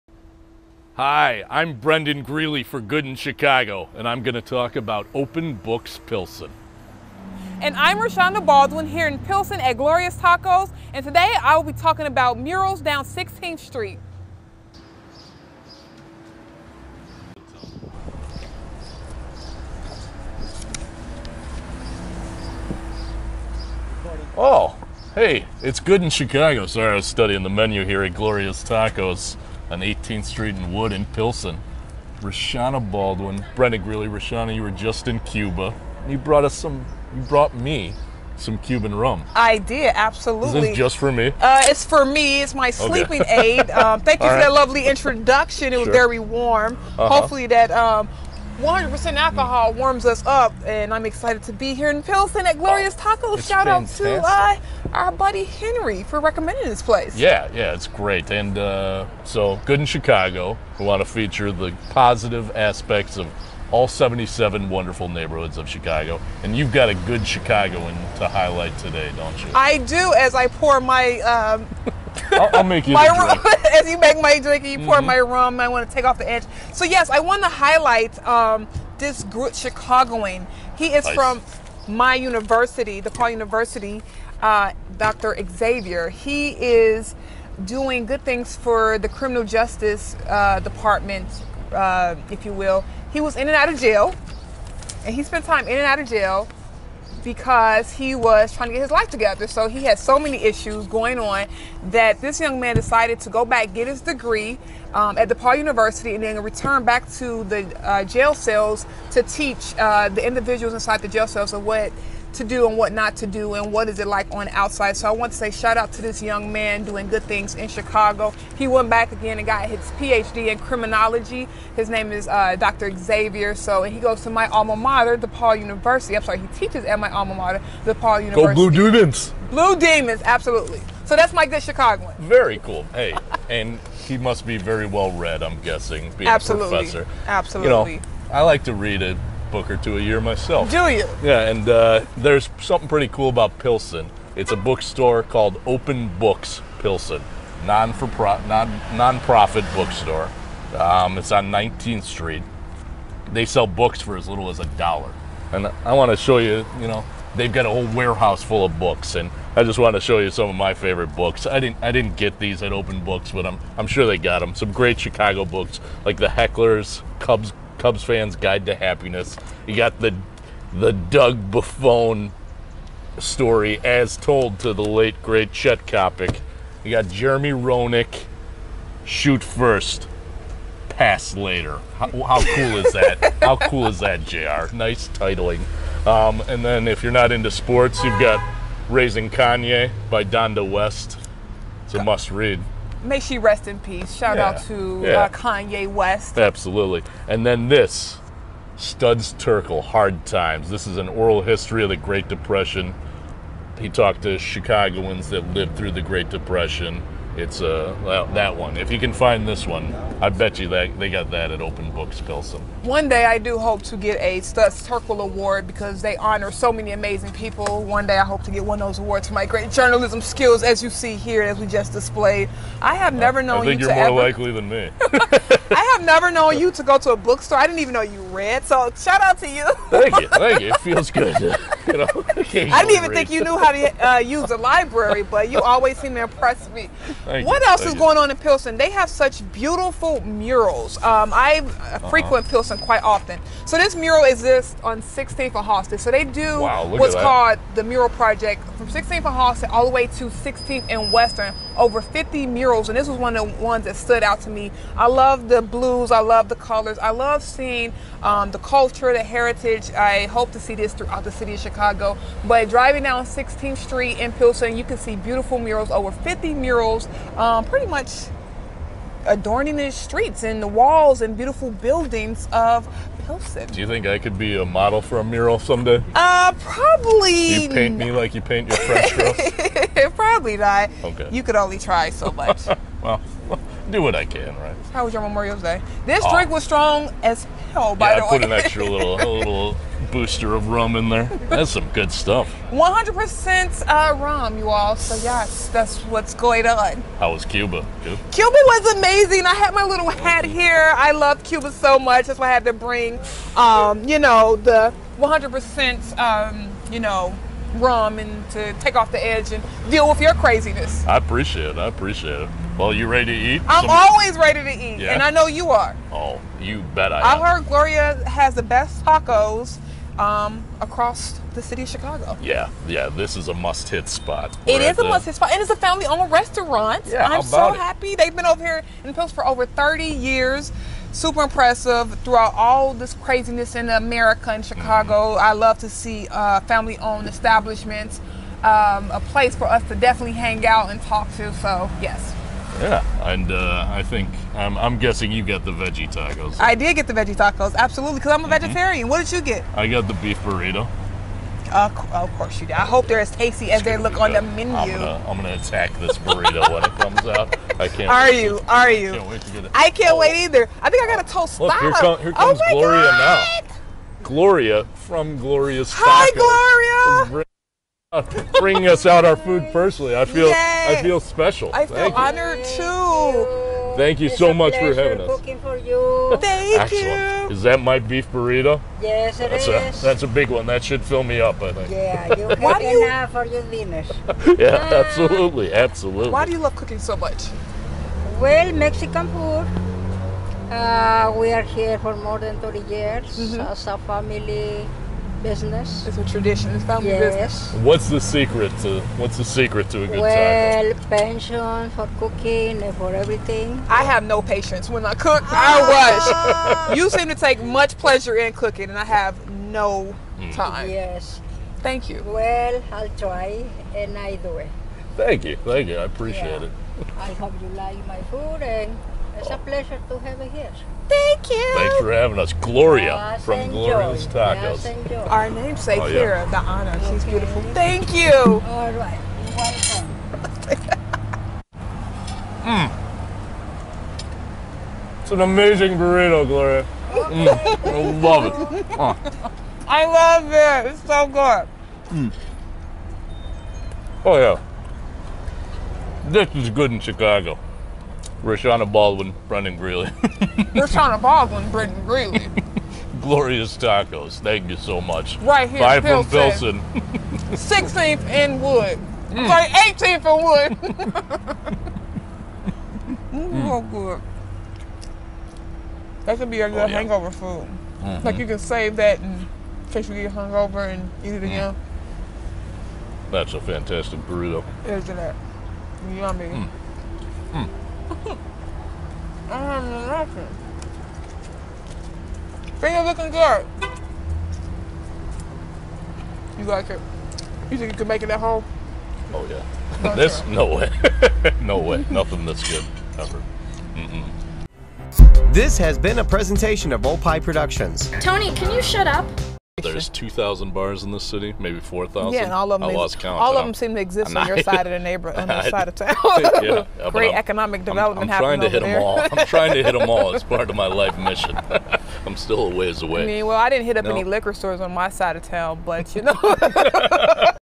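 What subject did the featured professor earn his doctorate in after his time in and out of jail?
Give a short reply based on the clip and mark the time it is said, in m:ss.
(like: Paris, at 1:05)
Criminology, at 2:00.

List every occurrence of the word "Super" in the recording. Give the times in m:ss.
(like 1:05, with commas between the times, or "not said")
5:31.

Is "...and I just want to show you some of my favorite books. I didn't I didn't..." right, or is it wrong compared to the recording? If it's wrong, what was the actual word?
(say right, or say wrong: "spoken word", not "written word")
right.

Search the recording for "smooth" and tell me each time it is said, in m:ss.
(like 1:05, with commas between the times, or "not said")
not said.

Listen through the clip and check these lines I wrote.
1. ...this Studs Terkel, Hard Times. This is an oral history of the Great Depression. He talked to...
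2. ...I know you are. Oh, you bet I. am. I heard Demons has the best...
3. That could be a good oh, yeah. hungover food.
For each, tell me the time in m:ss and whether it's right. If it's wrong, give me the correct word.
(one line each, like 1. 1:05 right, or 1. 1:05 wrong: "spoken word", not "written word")
1. 3:17 right
2. 5:15 wrong: "Gloria", not "Demons"
3. 7:46 wrong: "hangover", not "hungover".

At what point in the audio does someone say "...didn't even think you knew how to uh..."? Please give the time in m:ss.
3:52.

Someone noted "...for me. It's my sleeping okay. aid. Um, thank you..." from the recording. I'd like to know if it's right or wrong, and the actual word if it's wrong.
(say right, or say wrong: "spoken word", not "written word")
right.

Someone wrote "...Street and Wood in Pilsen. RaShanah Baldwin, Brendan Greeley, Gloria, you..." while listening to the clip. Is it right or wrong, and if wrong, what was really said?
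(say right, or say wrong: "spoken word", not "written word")
wrong: "RaShanah", not "Gloria".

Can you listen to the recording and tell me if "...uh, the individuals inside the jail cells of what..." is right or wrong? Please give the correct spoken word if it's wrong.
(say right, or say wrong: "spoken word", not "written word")
right.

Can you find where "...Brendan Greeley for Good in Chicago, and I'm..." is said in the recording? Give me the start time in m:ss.
0:01.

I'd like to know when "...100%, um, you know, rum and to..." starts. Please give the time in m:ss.
5:05.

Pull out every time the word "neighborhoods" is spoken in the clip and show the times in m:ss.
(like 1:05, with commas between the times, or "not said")
1:05, 8:24.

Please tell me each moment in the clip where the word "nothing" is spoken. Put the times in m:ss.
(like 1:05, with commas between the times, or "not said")
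8:00, 8:12.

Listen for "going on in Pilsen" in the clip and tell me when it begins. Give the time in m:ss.
3:57.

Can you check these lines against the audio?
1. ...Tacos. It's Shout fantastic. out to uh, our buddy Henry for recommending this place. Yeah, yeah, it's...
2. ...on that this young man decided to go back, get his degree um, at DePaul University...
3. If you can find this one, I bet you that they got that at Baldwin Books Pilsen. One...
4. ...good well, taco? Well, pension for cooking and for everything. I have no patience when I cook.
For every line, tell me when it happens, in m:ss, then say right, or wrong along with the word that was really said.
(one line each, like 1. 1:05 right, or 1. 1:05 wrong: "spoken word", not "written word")
1. 0:52 right
2. 1:41 right
3. 3:28 wrong: "Open", not "Baldwin"
4. 6:40 right.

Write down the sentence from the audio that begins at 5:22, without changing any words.
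Yeah, yeah, this is a must-hit spot.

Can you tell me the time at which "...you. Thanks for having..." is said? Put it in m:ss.
7:01.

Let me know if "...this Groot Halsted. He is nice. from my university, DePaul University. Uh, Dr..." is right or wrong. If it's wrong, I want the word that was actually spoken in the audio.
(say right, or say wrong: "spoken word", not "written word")
wrong: "Chicagoan", not "Halsted".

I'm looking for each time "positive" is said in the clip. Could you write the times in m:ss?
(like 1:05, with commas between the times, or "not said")
1:01.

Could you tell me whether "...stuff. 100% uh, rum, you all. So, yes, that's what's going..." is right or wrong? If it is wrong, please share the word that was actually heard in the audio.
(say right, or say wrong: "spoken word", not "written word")
right.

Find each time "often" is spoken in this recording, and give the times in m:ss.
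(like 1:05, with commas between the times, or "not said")
4:03.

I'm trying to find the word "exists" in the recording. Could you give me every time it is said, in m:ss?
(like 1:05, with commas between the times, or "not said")
4:04, 8:24.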